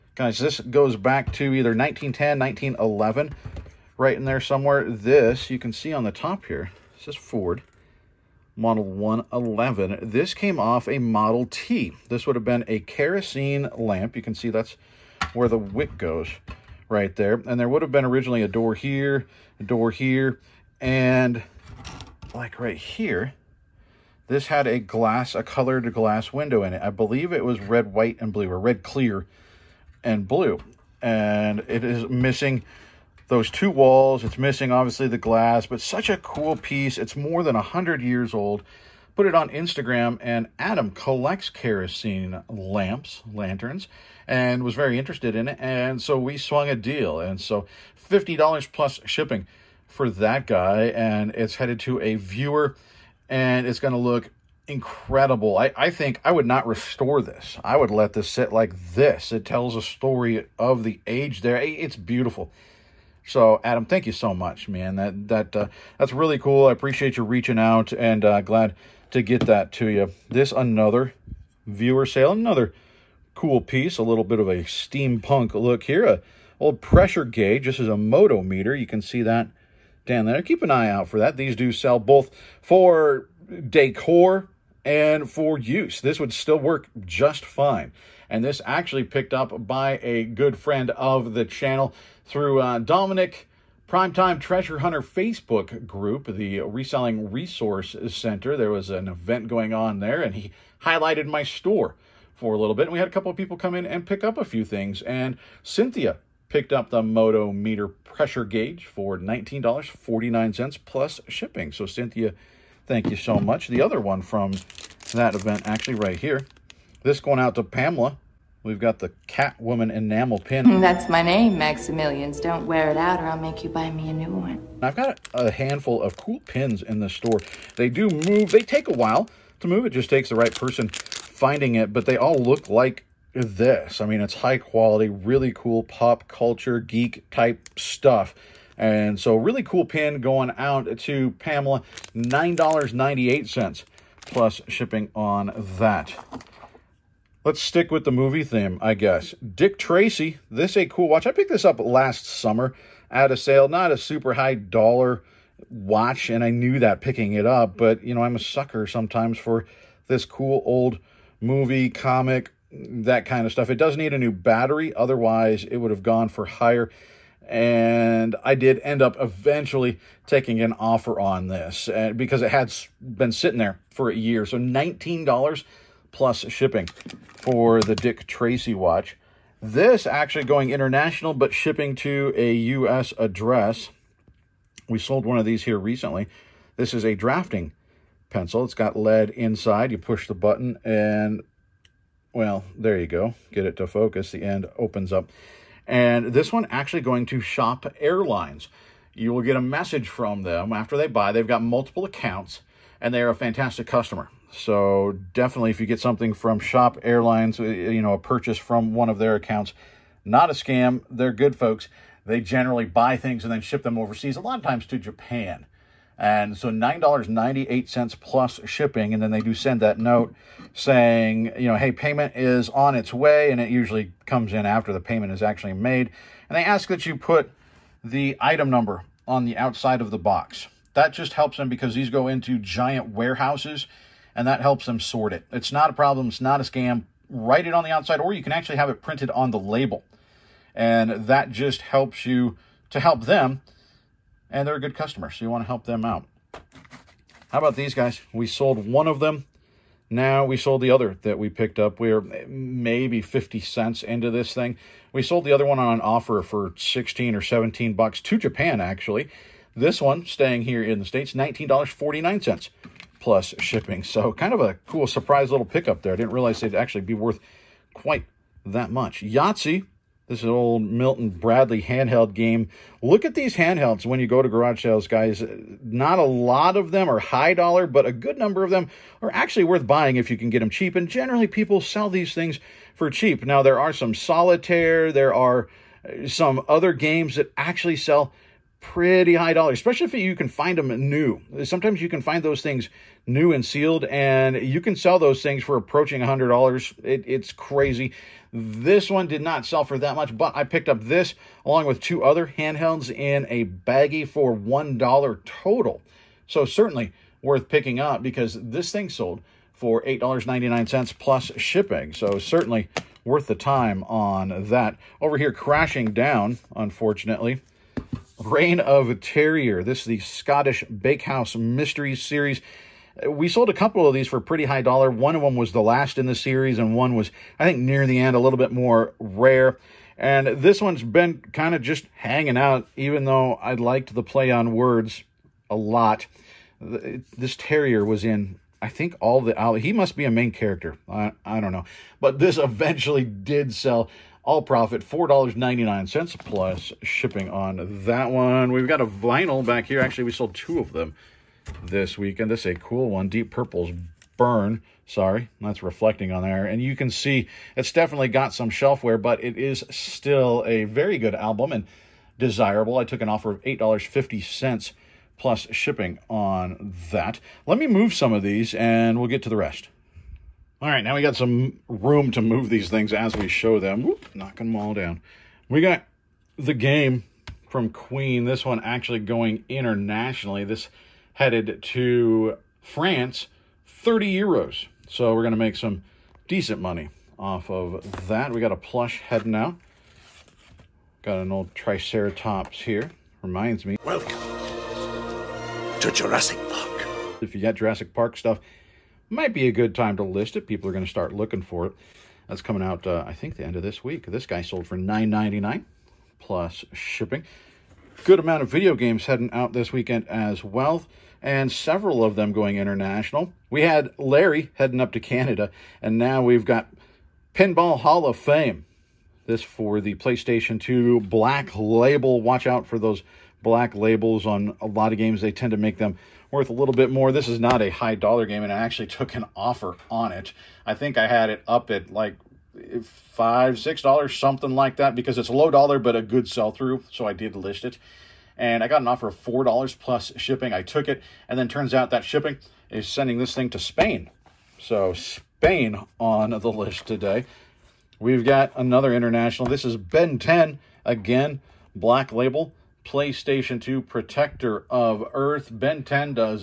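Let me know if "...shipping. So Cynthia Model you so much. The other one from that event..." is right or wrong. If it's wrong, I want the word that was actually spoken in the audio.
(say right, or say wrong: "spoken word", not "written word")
wrong: "Thank", not "Model".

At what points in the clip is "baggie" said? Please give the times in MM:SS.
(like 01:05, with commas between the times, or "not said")
05:03.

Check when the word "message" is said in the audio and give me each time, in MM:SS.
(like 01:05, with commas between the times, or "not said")
03:19.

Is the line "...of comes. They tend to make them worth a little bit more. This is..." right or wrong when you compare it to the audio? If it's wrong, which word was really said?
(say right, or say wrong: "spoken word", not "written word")
wrong: "games", not "comes".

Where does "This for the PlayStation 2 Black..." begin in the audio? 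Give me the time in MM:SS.
06:59.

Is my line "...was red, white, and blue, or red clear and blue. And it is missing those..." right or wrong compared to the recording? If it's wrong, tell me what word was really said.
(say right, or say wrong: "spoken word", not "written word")
right.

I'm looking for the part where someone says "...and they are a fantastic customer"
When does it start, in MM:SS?
03:23.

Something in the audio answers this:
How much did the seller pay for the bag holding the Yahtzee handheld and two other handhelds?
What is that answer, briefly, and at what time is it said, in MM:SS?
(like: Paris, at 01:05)
$1, at 05:04.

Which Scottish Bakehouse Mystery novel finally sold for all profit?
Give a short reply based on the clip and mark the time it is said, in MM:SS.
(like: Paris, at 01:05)
Reign of Terrier, at 05:18.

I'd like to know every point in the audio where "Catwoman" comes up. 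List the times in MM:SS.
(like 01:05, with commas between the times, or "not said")
01:59.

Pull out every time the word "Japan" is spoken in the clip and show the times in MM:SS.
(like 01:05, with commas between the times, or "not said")
03:34, 04:18.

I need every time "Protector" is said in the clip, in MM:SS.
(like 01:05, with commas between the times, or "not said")
07:34.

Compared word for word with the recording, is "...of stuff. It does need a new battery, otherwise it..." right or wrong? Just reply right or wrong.
right.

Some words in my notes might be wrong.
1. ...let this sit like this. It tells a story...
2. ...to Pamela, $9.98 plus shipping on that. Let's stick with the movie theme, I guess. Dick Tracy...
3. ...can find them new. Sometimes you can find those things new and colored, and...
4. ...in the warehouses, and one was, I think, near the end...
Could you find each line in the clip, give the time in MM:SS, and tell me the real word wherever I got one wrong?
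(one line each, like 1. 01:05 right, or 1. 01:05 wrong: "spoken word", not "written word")
1. 00:57 right
2. 02:20 right
3. 04:50 wrong: "sealed", not "colored"
4. 05:26 wrong: "series", not "warehouses".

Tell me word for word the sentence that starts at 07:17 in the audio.
So I did list it, and I got an offer of four dollars plus shipping.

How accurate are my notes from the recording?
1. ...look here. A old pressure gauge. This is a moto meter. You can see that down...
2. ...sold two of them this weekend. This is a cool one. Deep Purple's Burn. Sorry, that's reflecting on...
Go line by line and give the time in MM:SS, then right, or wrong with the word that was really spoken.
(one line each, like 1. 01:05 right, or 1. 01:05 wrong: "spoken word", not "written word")
1. 01:15 right
2. 05:50 right.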